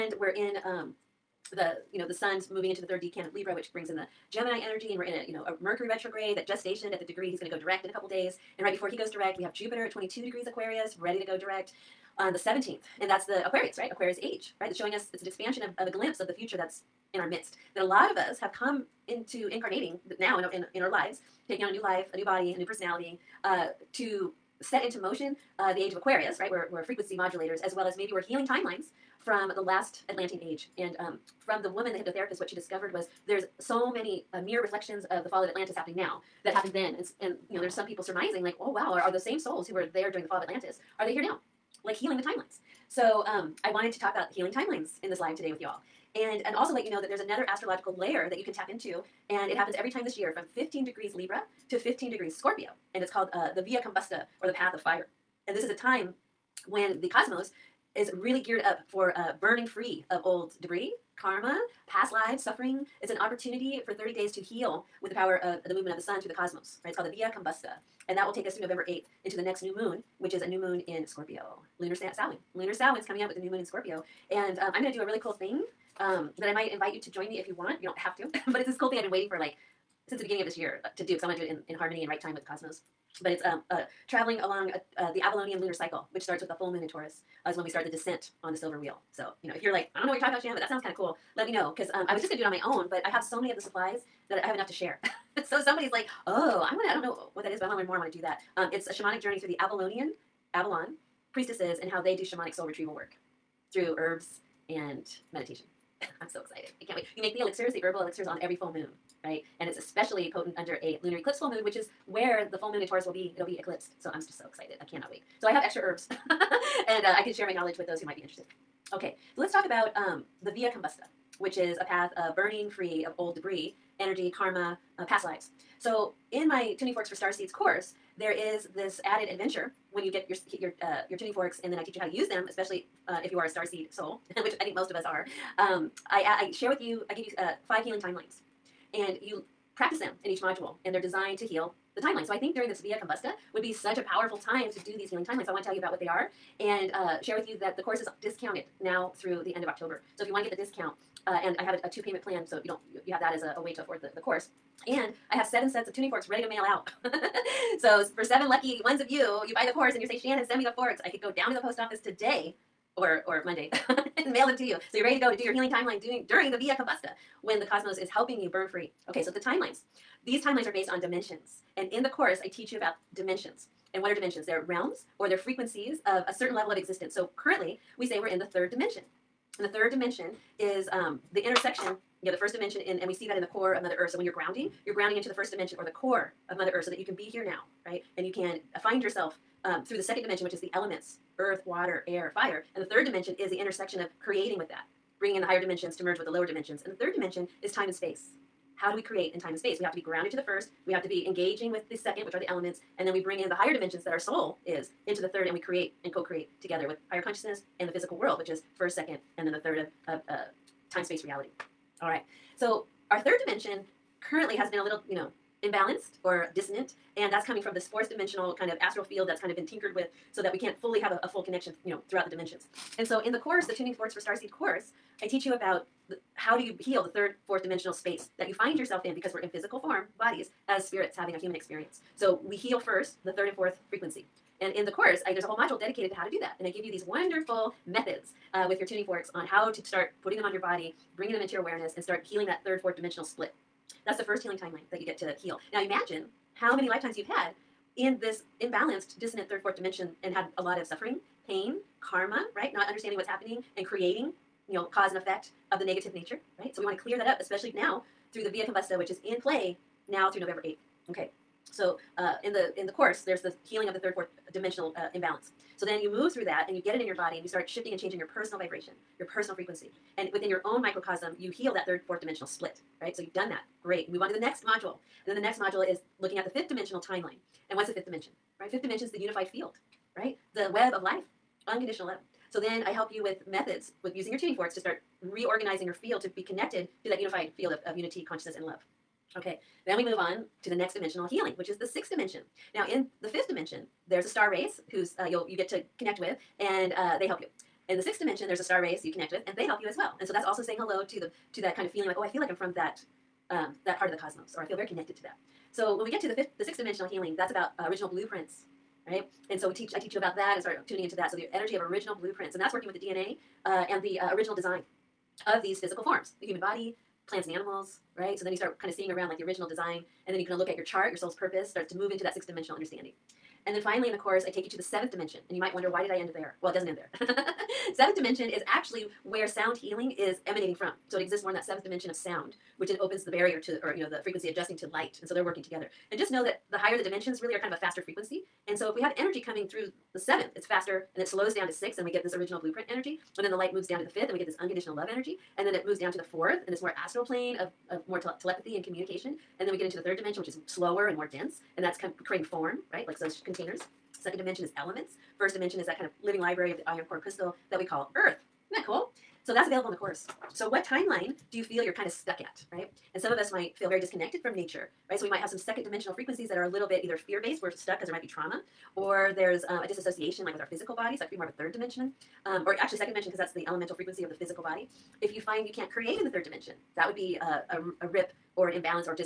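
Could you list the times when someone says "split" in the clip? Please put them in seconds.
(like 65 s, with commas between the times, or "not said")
243 s, 272 s.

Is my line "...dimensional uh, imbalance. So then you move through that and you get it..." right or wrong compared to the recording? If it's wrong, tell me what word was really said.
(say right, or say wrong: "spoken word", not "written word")
right.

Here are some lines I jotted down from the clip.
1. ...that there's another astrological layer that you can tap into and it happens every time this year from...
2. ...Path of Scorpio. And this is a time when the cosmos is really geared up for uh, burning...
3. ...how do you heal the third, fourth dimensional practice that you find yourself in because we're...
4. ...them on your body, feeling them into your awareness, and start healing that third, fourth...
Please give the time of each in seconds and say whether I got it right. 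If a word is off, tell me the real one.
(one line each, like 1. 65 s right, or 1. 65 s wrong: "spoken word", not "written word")
1. 47 s right
2. 54 s wrong: "Fire", not "Scorpio"
3. 226 s wrong: "space", not "practice"
4. 240 s wrong: "bringing", not "feeling".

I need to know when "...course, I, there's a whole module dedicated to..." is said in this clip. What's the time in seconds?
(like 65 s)
234 s.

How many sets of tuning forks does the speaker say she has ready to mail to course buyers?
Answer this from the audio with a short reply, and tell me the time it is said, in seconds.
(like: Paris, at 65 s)
7, at 155 s.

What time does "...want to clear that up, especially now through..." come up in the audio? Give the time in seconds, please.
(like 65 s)
256 s.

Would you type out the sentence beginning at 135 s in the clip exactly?
Um, I, I share with you, I give you uh, five healing timelines.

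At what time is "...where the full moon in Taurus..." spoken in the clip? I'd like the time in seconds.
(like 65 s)
112 s.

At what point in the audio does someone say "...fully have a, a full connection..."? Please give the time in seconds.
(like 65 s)
220 s.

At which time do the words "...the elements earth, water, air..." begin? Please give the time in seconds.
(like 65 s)
190 s.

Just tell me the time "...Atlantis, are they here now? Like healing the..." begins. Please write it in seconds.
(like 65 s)
40 s.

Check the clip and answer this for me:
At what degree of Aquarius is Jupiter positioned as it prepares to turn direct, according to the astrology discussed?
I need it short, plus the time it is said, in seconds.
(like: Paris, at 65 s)
22, at 9 s.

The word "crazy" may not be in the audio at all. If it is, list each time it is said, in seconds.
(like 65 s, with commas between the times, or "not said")
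not said.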